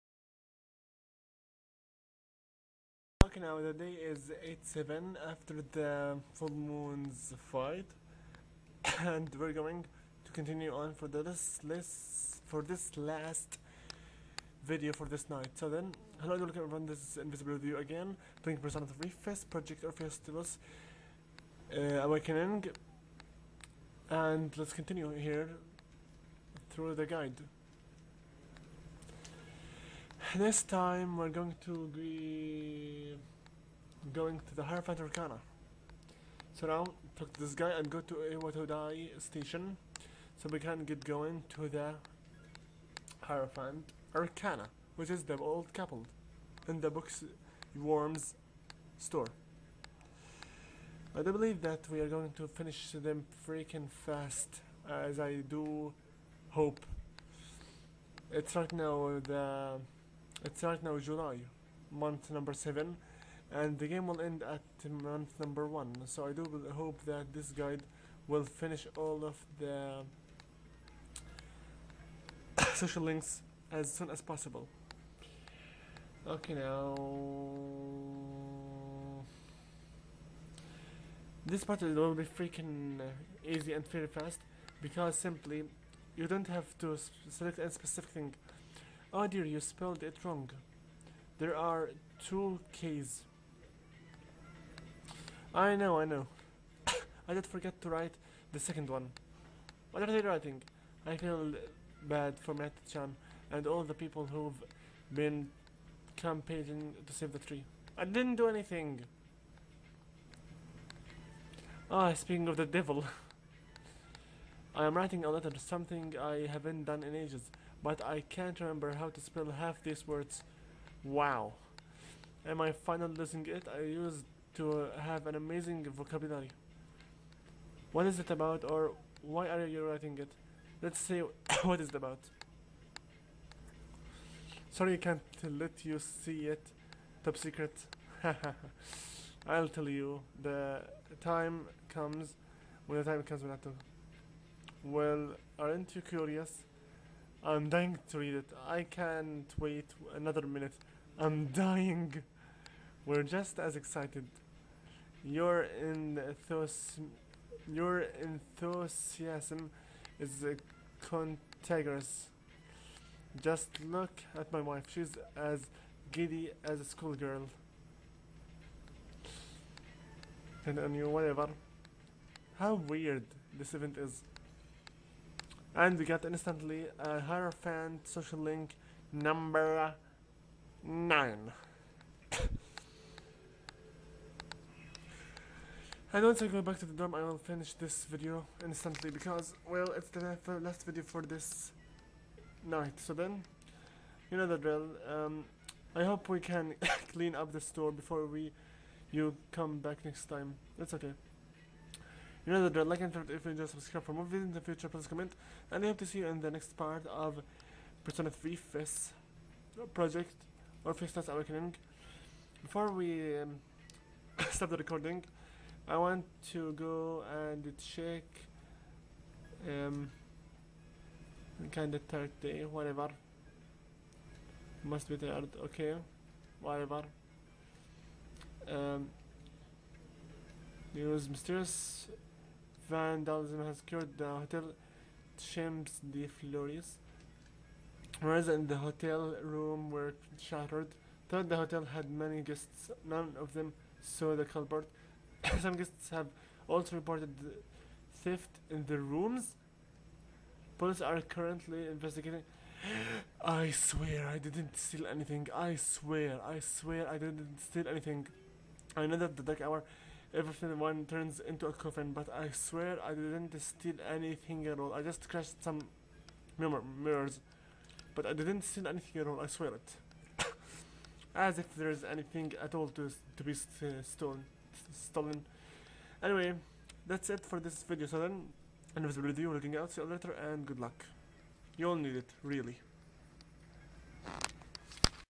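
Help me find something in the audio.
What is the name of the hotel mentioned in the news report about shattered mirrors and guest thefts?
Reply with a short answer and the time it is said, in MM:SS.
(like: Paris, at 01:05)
Champs de Flores, at 03:55.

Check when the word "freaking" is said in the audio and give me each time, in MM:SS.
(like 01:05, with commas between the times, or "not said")
00:53, 01:22.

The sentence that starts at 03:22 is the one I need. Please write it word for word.
like and if you enjoy, subscribe for more videos in the future, please comment.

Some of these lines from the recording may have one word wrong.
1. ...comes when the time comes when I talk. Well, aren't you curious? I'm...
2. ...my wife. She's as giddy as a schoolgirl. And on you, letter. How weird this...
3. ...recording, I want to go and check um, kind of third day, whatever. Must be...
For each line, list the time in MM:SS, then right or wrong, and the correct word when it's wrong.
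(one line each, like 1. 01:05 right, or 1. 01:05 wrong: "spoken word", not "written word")
1. 02:21 right
2. 02:44 wrong: "whatever", not "letter"
3. 03:34 right.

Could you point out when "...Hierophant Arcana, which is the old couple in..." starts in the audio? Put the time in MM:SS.
00:43.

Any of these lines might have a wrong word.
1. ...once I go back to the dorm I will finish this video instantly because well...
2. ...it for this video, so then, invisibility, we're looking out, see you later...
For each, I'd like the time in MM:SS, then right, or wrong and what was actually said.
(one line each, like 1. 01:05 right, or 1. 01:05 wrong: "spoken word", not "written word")
1. 03:06 right
2. 04:37 right.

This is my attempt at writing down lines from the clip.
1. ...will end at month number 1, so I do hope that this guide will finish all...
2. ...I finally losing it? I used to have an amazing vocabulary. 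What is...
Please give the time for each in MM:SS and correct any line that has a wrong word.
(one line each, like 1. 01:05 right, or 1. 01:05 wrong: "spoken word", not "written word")
1. 01:04 right
2. 02:02 right.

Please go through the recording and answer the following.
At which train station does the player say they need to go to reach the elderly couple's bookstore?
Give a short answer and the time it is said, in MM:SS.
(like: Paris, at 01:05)
Iwatodai station, at 00:38.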